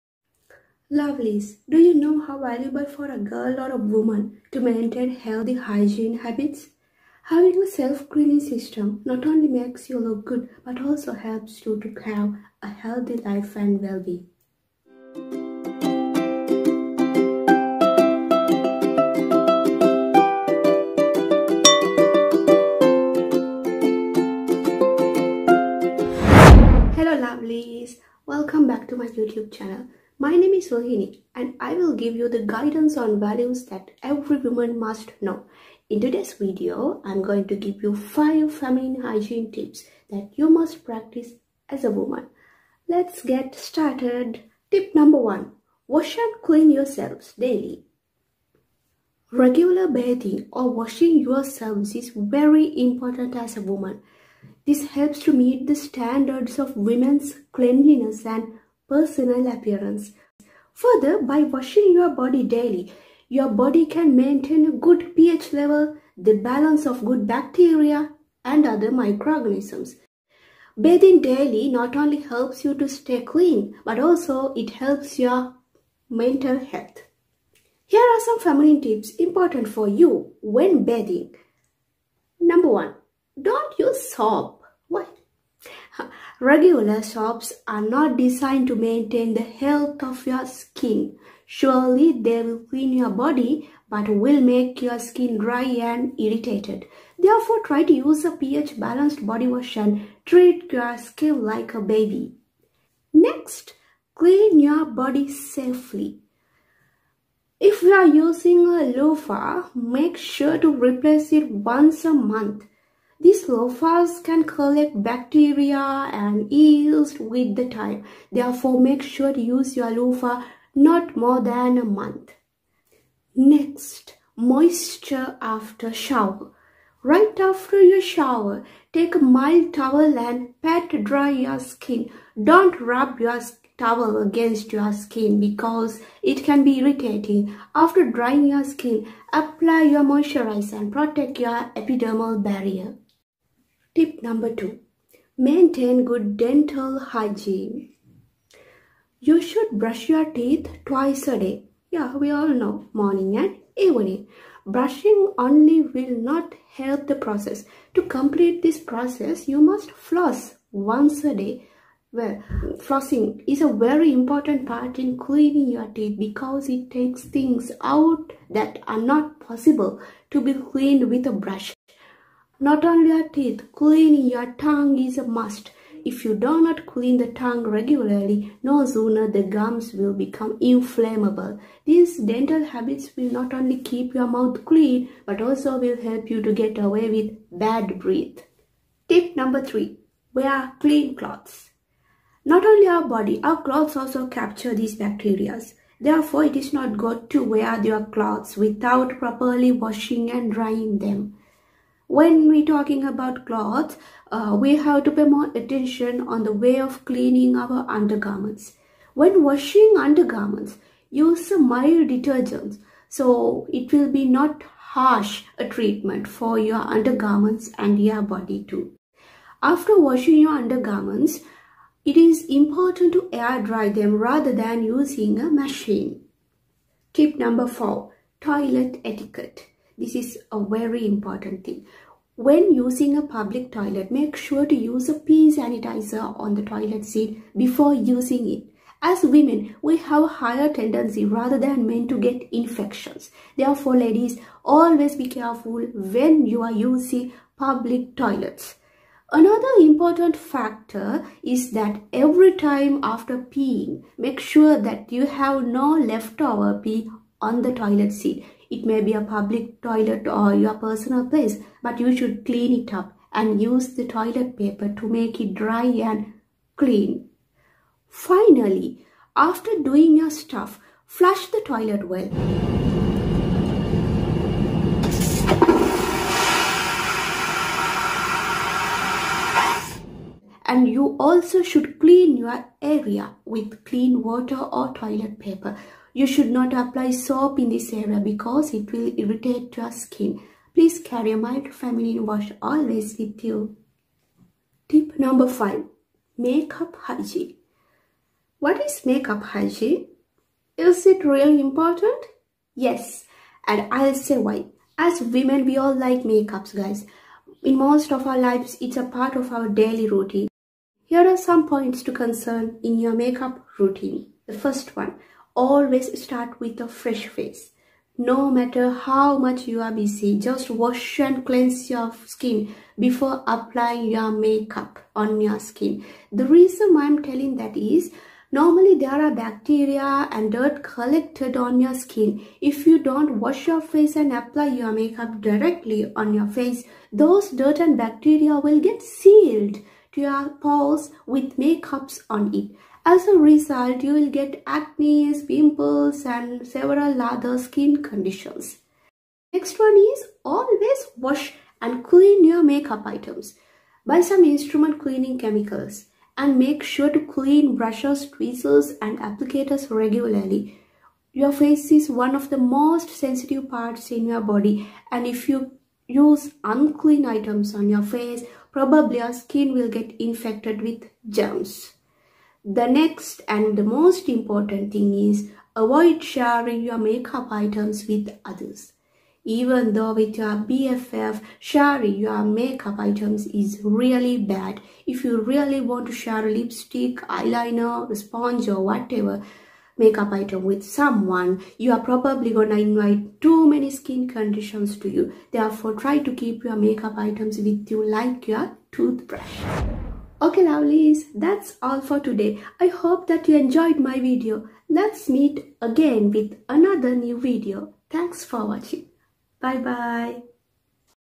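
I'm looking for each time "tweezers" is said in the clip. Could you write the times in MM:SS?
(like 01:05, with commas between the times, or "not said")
05:58.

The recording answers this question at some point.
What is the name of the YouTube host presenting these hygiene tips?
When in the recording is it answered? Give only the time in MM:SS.
00:30.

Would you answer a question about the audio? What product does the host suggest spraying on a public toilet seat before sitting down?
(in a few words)
Pee sanitizer.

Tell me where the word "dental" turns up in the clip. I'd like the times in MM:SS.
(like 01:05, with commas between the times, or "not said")
02:26, 03:02.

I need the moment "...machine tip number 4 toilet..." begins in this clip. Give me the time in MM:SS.
03:45.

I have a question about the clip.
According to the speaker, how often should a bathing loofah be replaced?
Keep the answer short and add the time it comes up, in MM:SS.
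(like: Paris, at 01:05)
Once a month, at 01:51.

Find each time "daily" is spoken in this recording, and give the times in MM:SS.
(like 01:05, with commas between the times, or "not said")
00:47, 01:02, 01:11, 05:09.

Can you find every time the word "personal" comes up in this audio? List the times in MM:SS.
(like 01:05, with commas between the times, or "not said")
00:58, 04:20.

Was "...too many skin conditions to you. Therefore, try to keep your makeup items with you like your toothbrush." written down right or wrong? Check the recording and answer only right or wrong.
right.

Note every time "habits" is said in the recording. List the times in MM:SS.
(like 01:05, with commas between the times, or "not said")
00:06, 03:02.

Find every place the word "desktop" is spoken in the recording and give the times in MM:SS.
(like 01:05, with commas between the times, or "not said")
not said.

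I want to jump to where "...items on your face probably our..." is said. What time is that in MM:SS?
06:07.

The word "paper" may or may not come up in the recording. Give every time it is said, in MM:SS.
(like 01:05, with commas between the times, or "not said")
04:24, 04:45.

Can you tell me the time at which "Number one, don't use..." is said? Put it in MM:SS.
01:22.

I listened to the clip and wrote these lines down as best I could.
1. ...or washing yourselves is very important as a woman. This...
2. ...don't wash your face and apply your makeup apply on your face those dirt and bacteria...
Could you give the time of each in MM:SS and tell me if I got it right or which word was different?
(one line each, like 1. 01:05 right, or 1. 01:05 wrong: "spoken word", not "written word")
1. 00:50 right
2. 05:33 wrong: "directly", not "apply".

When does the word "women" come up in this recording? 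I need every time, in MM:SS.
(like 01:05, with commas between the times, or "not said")
00:56, 03:59, 05:05.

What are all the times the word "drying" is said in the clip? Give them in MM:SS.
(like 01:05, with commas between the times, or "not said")
02:18, 03:20.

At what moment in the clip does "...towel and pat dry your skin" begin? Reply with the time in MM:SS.
02:09.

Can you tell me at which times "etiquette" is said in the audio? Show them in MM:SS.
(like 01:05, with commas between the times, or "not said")
03:49.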